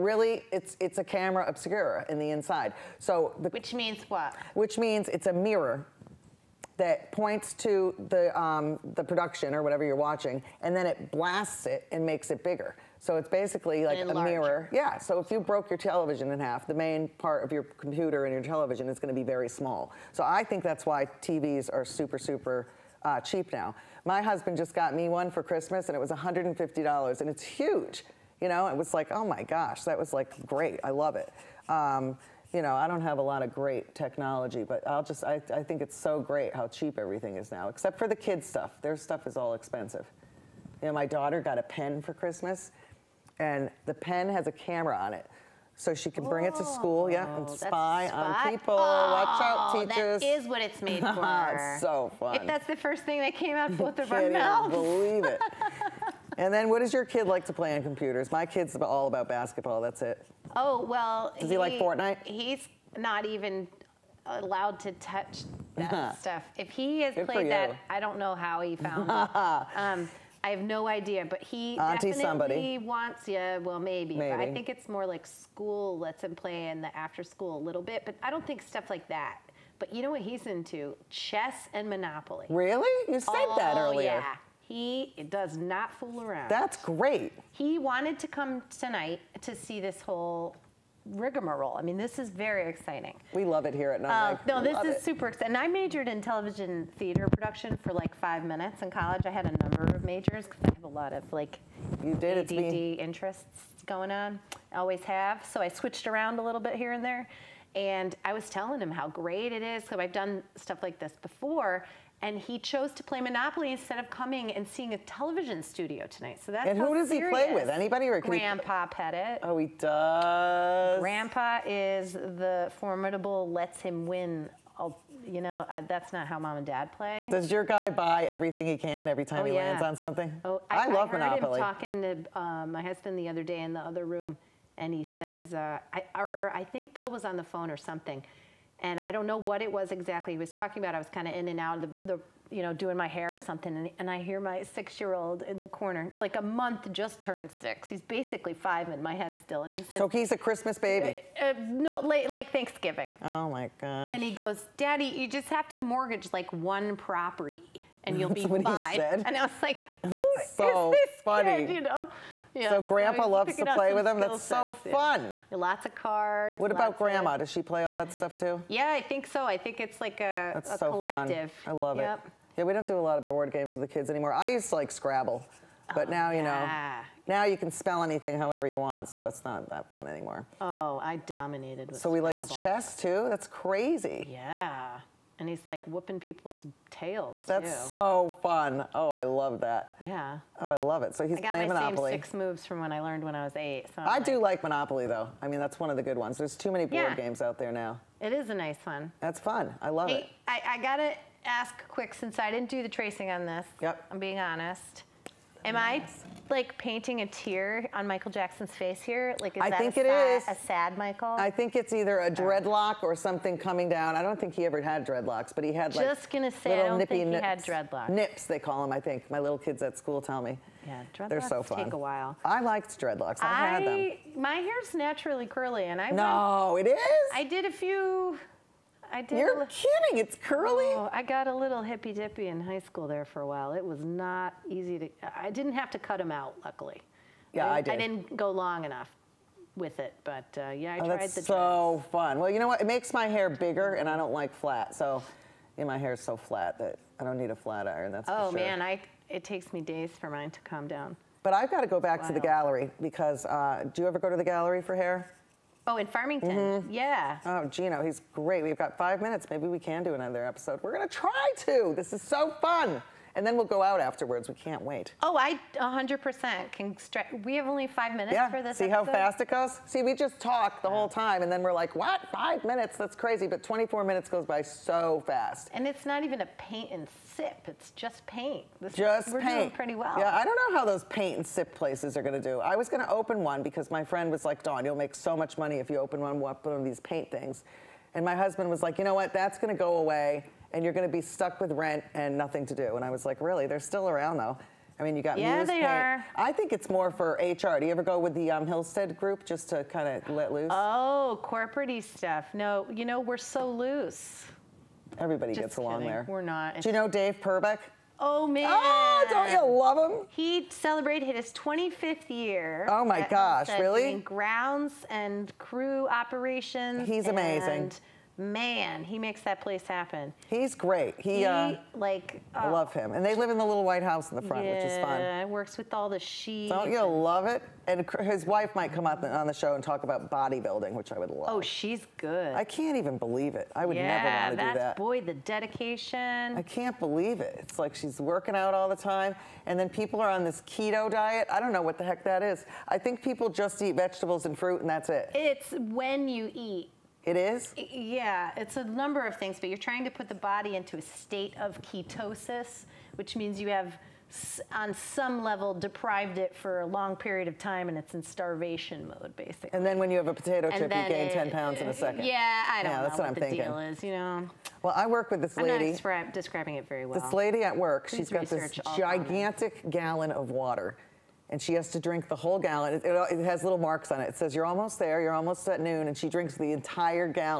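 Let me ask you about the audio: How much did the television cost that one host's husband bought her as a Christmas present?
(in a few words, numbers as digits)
$150.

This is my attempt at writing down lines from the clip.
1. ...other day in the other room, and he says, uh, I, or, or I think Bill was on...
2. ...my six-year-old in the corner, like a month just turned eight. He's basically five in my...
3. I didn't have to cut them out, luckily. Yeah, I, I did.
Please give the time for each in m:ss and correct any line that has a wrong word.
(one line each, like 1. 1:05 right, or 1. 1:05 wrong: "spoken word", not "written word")
1. 2:13 right
2. 2:24 wrong: "six", not "eight"
3. 3:55 right.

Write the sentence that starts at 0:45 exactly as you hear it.
So she can bring oh, it to school, yeah, and oh, spy, on people.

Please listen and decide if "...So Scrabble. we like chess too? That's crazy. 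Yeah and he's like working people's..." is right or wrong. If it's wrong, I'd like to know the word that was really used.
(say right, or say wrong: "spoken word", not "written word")
wrong: "whooping", not "working".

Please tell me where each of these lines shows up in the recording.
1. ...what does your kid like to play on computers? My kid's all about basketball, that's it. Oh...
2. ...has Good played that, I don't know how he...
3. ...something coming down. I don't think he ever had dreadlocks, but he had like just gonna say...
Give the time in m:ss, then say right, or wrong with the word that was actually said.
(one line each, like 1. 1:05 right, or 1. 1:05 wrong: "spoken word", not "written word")
1. 0:56 right
2. 1:07 right
3. 3:33 right.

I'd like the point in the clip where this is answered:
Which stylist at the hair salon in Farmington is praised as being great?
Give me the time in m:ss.
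4:17.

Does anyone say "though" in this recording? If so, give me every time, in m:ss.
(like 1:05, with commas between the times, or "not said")
3:15, 4:54.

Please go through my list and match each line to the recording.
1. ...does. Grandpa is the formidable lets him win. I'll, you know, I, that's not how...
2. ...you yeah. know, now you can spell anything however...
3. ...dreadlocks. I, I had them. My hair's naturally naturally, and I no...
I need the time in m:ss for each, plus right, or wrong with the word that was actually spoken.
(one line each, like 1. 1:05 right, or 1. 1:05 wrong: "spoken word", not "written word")
1. 1:59 right
2. 2:56 right
3. 3:43 wrong: "curly", not "naturally".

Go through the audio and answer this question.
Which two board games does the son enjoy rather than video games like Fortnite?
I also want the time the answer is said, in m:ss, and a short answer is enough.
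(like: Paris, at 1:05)
Chess and Monopoly, at 1:21.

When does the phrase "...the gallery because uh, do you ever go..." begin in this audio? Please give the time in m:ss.
4:12.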